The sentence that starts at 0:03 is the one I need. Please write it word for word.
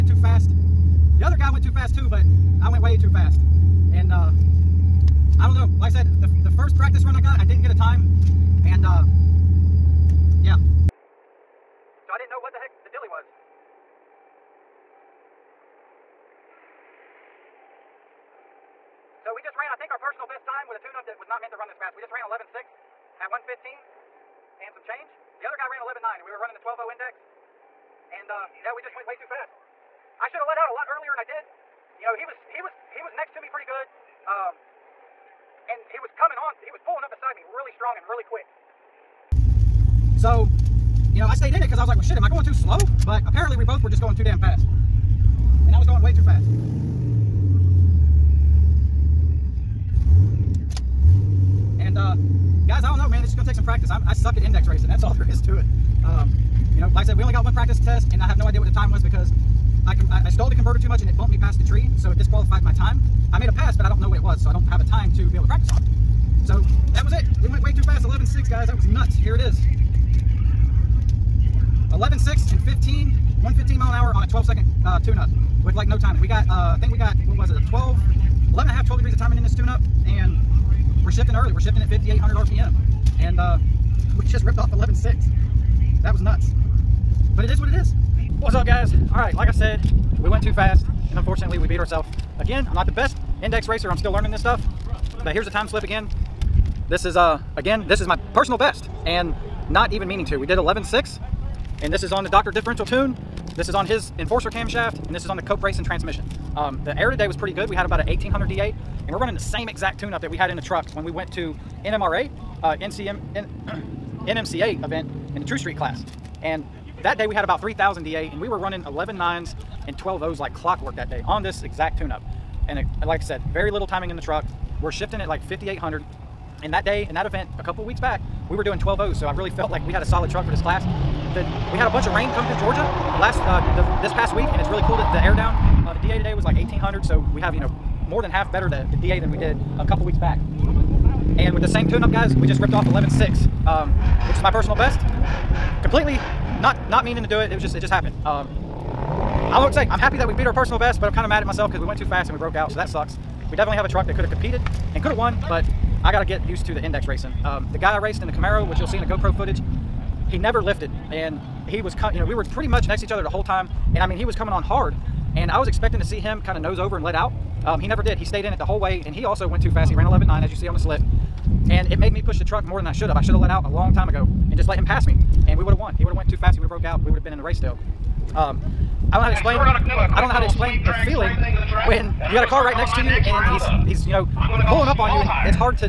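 And uh, I don't know, like I said, the, the first practice run I got, I didn't get a time.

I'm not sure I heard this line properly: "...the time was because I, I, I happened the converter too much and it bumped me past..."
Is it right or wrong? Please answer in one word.
wrong.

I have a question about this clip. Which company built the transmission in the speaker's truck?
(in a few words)
Cope Racing.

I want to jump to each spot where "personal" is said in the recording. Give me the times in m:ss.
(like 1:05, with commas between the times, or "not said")
0:20, 1:38, 2:24, 2:30.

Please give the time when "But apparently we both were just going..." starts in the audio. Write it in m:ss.
0:43.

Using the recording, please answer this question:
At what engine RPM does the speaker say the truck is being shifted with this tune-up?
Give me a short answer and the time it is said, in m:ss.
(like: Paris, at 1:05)
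5,800, at 1:21.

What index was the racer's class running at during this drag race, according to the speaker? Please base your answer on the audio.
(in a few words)
12.0.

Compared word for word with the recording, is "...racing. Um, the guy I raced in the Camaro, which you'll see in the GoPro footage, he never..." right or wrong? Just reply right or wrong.
right.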